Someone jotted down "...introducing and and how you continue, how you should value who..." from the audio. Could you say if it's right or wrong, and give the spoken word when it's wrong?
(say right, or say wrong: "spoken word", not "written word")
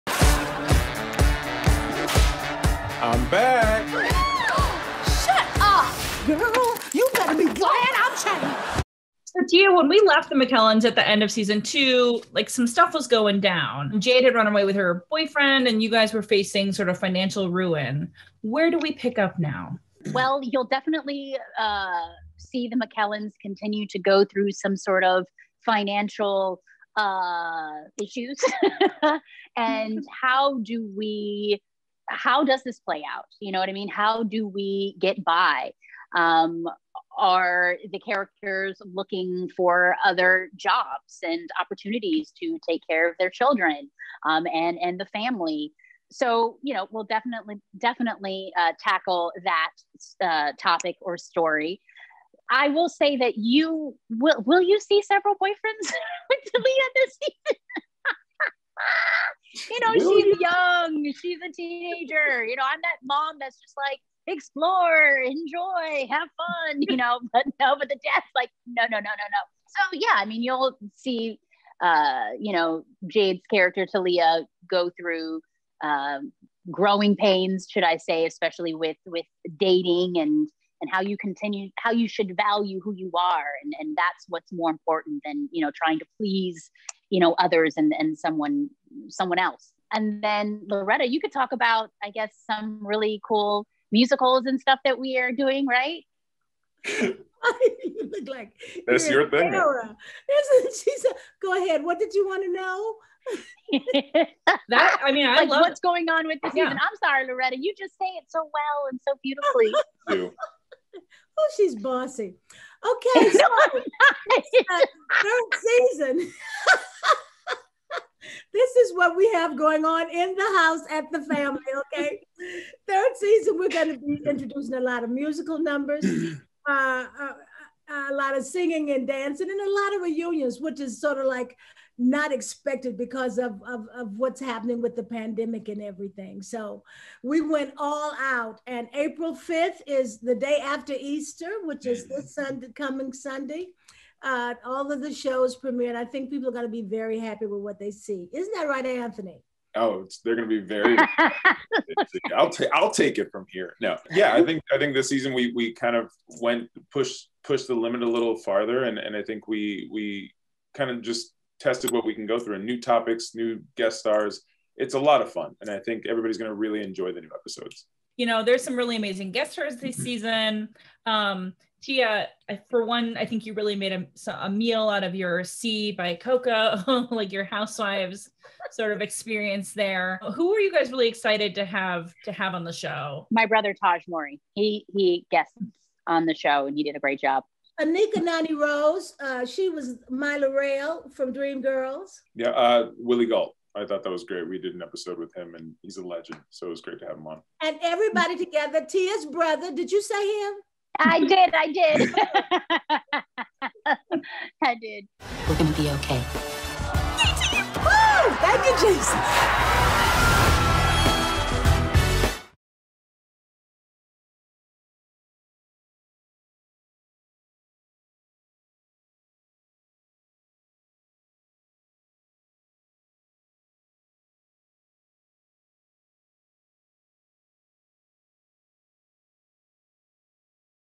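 wrong: "dating", not "introducing".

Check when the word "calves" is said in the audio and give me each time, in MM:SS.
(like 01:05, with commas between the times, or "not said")
not said.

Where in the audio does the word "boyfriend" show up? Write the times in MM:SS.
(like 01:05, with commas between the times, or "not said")
00:15, 00:55.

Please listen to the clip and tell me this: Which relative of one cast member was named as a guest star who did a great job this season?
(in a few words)
Tahj Mowry.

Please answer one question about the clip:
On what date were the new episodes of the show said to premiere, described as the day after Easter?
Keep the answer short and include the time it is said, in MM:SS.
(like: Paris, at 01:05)
April 5th, at 02:18.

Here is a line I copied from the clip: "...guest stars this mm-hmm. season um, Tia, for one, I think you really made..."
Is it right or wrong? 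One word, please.
right.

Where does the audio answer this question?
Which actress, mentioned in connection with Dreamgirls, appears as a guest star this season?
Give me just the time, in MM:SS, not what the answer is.
03:07.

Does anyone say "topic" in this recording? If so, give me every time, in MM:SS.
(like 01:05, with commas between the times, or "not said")
00:50, 02:42.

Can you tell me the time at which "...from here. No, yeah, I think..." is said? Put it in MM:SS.
02:33.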